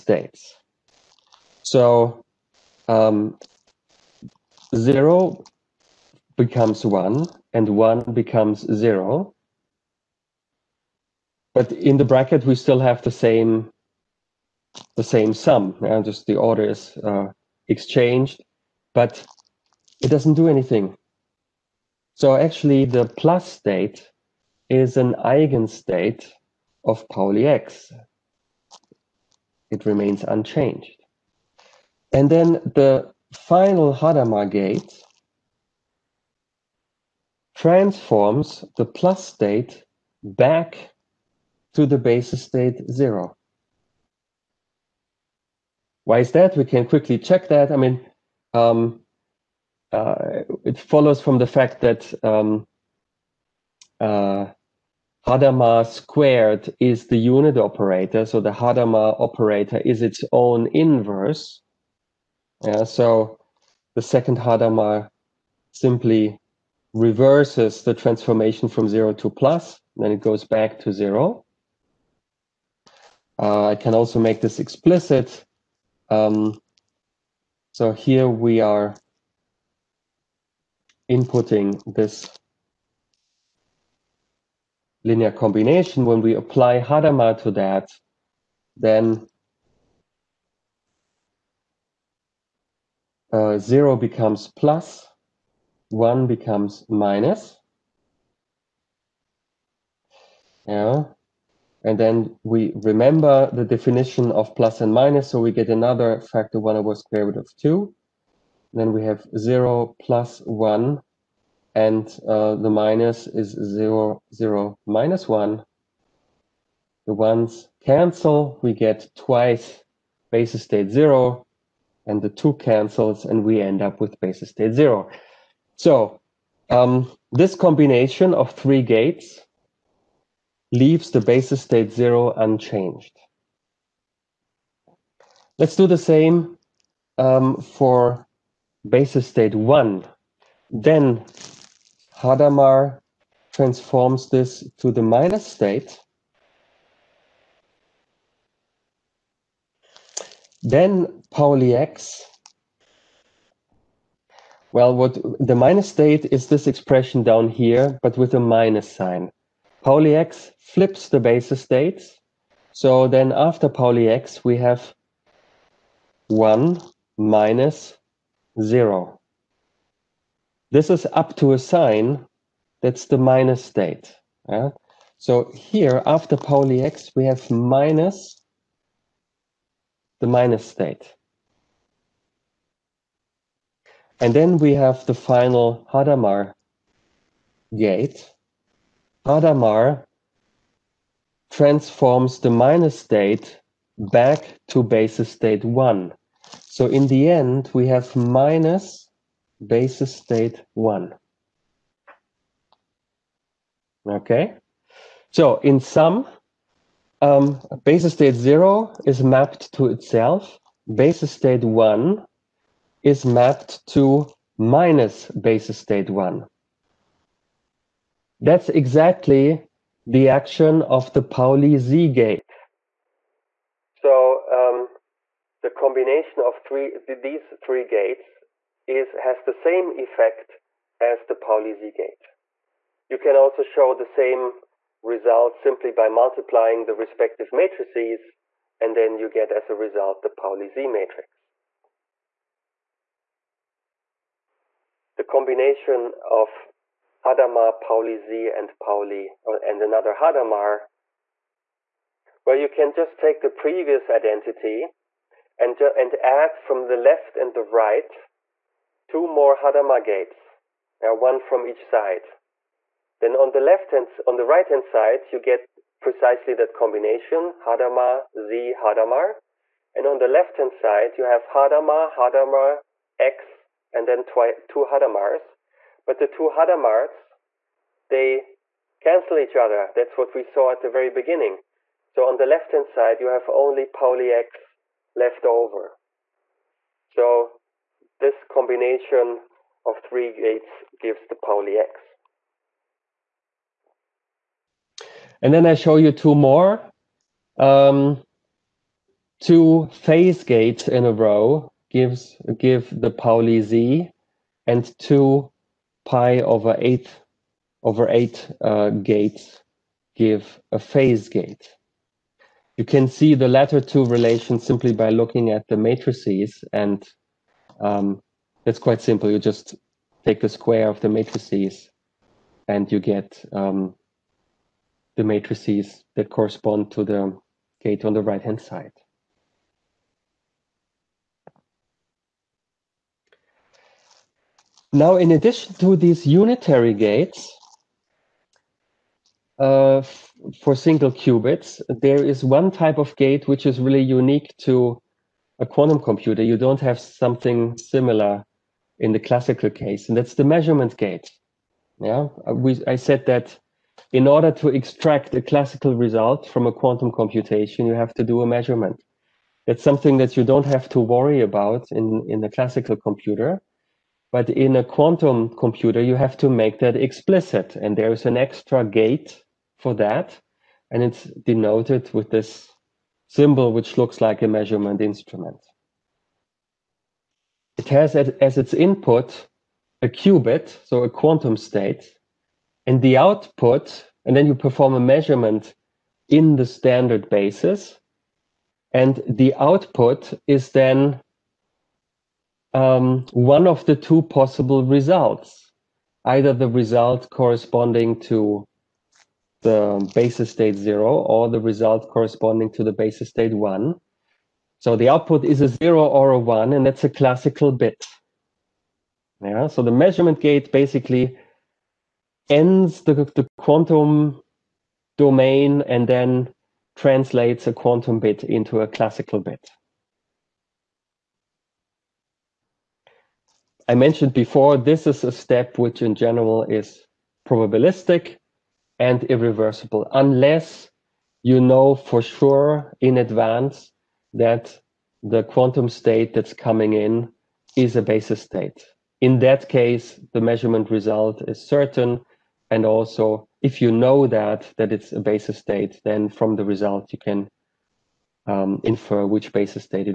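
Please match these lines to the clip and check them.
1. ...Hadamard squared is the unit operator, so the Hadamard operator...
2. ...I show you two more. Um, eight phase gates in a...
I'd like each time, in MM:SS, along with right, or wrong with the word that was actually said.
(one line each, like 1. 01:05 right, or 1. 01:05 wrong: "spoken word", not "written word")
1. 00:55 right
2. 04:55 wrong: "two", not "eight".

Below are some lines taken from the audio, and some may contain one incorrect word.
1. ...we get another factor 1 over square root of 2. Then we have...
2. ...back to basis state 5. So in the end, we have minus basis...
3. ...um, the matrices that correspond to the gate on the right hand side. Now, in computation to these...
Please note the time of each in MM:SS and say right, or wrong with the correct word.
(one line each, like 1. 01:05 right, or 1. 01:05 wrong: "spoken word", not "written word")
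1. 01:45 right
2. 03:13 wrong: "1", not "5"
3. 05:23 wrong: "addition", not "computation".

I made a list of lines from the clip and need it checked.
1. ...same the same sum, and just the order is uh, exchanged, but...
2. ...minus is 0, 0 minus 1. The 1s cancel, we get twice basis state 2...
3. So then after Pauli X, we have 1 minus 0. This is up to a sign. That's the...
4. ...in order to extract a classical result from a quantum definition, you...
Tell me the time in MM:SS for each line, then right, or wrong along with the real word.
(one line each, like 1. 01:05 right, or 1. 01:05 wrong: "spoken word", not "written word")
1. 00:13 right
2. 01:52 wrong: "0", not "2"
3. 02:42 right
4. 05:54 wrong: "computation", not "definition".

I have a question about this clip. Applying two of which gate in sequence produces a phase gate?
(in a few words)
pi over 8 gates.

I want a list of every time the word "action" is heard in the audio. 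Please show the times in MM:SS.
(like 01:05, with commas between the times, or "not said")
03:40.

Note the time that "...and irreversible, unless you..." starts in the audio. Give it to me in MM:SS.
07:08.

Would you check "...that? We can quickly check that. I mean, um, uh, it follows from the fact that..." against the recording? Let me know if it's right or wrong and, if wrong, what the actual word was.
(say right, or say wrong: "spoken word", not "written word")
right.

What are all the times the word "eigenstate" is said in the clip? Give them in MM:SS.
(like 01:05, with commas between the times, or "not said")
00:25.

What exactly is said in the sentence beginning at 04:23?
Then on the left hand, on the right hand side, you get precisely that combination, Hadamard, Z, Hadamard.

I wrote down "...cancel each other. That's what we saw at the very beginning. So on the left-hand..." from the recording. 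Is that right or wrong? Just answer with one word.
right.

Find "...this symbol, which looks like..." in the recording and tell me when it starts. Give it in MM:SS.
06:12.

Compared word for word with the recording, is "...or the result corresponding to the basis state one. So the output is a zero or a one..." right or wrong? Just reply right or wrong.
right.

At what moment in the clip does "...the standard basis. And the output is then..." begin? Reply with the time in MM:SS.
06:26.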